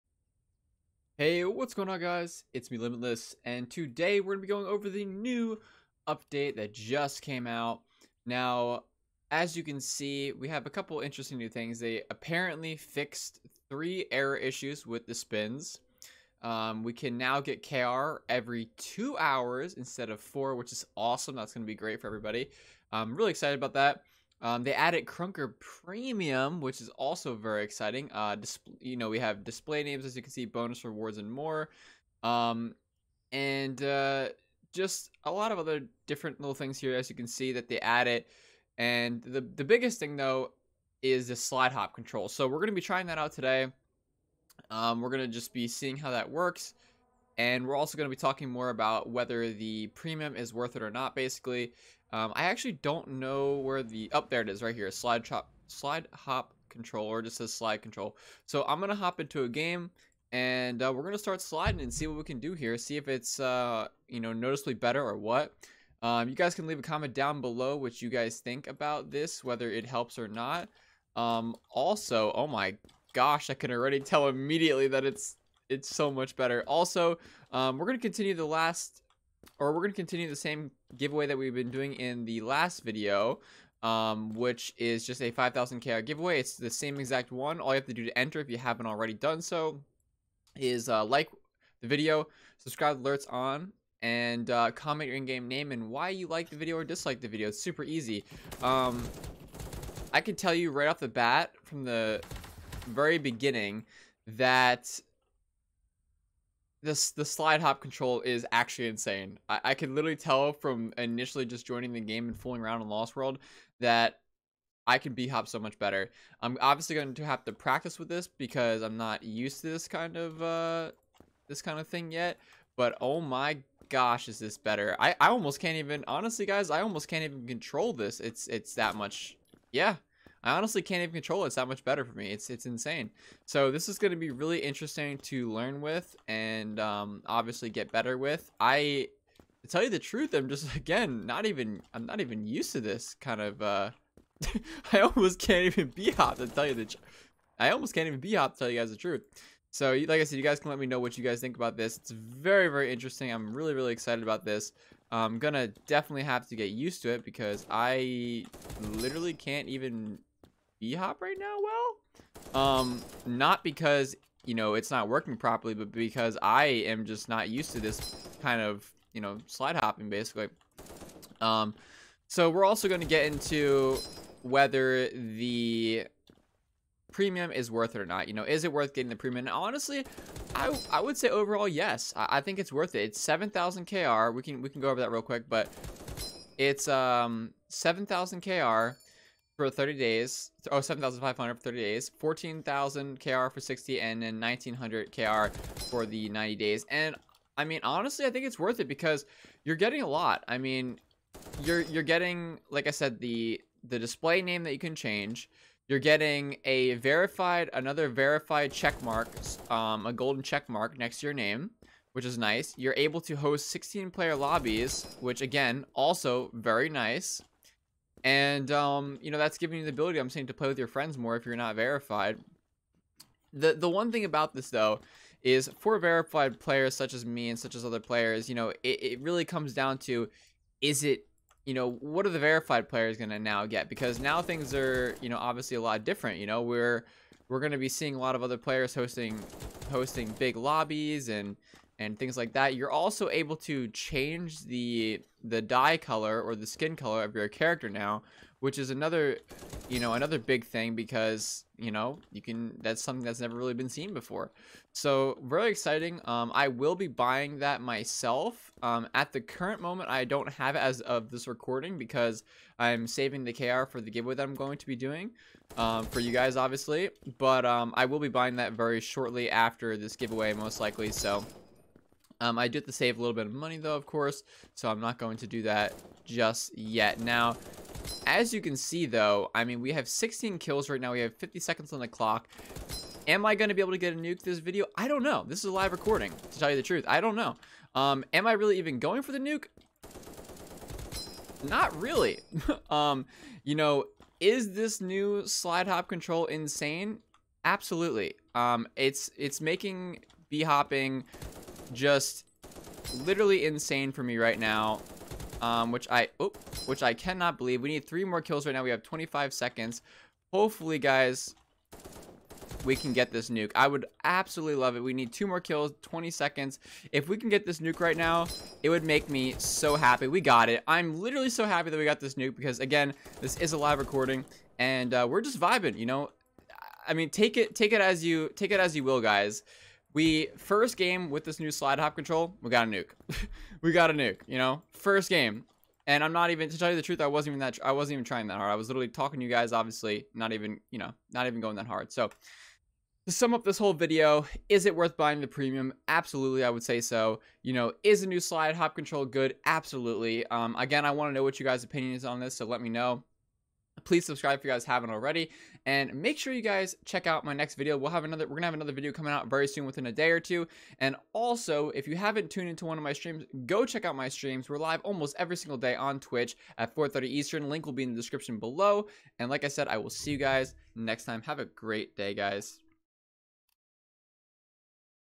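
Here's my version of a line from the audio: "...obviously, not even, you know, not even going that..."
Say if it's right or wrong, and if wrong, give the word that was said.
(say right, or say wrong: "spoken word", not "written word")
right.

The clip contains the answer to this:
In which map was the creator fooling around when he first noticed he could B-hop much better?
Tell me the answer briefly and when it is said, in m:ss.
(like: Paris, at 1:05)
Lost World, at 1:52.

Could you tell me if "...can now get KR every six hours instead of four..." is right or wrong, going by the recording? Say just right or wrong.
wrong.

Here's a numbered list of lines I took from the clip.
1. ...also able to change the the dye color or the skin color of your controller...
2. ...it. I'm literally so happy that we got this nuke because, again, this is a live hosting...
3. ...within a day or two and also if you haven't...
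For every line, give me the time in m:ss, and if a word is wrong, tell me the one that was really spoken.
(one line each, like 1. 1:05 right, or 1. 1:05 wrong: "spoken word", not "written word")
1. 4:02 wrong: "character", not "controller"
2. 5:20 wrong: "recording", not "hosting"
3. 5:59 right.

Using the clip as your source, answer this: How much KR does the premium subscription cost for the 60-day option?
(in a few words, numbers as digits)
14,000 KR.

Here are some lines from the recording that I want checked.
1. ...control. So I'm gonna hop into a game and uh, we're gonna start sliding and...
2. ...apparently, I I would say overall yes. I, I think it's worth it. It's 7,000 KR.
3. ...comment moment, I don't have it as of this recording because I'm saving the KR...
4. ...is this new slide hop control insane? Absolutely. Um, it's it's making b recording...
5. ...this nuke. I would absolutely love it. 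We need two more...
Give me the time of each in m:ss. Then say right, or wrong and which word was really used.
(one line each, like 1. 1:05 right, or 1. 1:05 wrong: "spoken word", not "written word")
1. 0:57 right
2. 2:59 wrong: "honestly", not "apparently"
3. 4:19 wrong: "current", not "comment"
4. 4:54 wrong: "hopping", not "recording"
5. 5:13 right.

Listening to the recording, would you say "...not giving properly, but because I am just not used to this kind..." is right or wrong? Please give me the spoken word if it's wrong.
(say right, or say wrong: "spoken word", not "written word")
wrong: "working", not "giving".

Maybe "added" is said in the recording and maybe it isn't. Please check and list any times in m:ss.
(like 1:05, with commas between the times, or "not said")
0:24, 0:37.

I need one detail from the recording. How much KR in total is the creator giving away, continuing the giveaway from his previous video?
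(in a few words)
5,000 KR.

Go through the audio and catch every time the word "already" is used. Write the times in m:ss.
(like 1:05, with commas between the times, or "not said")
1:13, 1:28, 5:55.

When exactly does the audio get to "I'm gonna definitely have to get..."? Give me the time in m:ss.
2:35.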